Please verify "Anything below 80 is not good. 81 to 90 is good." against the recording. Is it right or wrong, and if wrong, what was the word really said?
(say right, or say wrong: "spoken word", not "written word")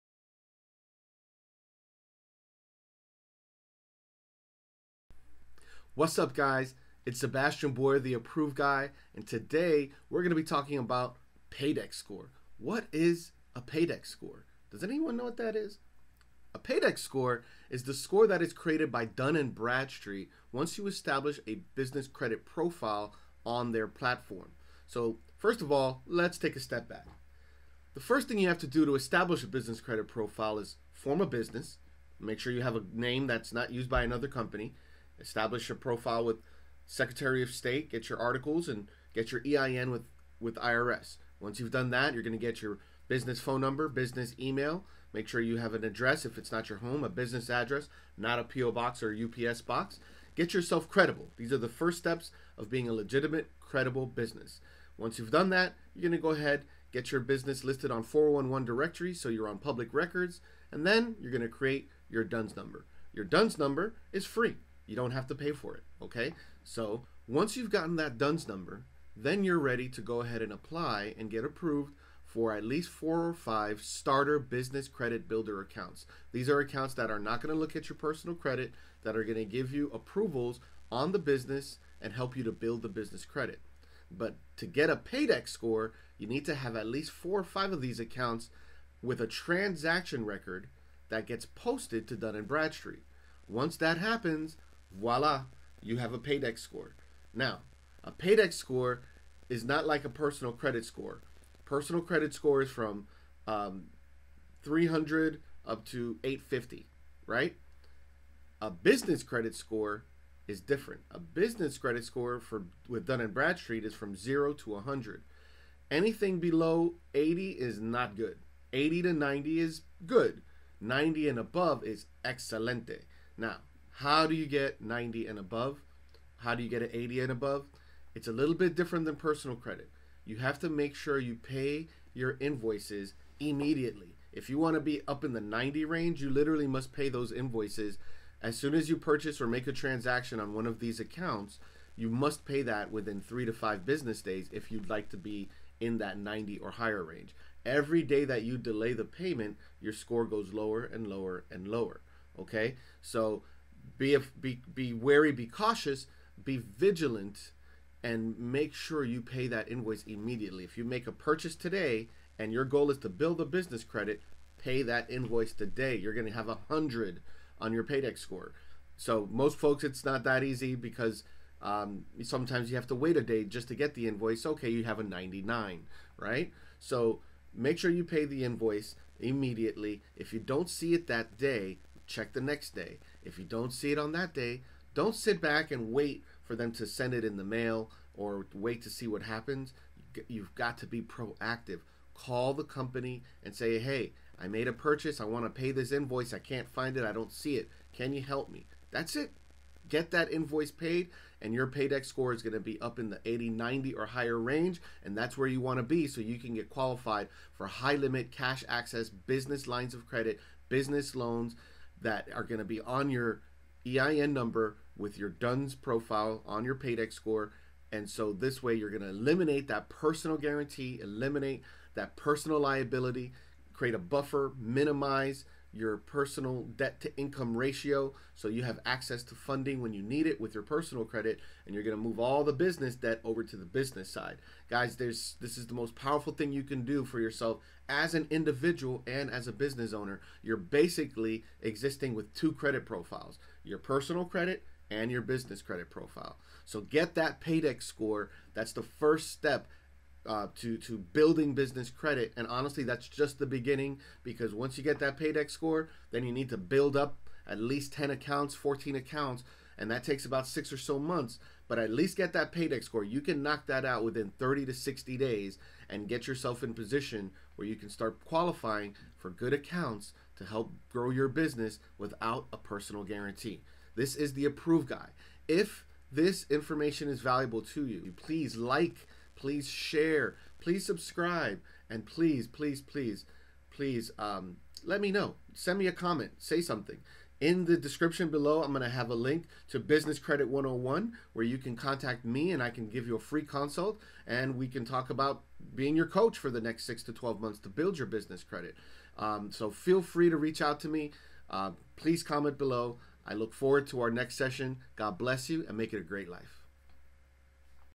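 wrong: "80", not "81".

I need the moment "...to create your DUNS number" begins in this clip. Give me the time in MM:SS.
01:01.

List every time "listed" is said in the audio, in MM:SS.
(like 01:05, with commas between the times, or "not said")
00:57.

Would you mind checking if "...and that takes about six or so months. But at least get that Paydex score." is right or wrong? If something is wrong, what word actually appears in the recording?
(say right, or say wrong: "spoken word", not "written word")
right.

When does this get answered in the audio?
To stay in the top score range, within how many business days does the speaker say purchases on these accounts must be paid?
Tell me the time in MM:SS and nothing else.
02:23.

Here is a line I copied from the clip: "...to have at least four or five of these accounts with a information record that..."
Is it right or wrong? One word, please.
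wrong.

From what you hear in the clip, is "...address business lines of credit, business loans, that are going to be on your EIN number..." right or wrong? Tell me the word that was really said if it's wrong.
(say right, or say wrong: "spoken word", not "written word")
wrong: "access", not "address".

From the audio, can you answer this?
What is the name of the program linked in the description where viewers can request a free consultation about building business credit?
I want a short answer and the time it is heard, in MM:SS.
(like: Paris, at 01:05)
Business Credit 101, at 04:49.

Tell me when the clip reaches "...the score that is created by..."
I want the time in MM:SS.
00:17.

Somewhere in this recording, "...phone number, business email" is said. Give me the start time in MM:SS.
00:43.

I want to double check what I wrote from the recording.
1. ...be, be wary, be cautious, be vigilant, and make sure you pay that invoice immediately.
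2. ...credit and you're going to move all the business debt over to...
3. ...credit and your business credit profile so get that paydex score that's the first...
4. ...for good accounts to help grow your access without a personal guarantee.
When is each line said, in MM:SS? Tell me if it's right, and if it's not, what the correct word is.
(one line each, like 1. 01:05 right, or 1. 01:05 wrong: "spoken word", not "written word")
1. 02:34 right
2. 03:51 right
3. 04:04 right
4. 04:29 wrong: "business", not "access".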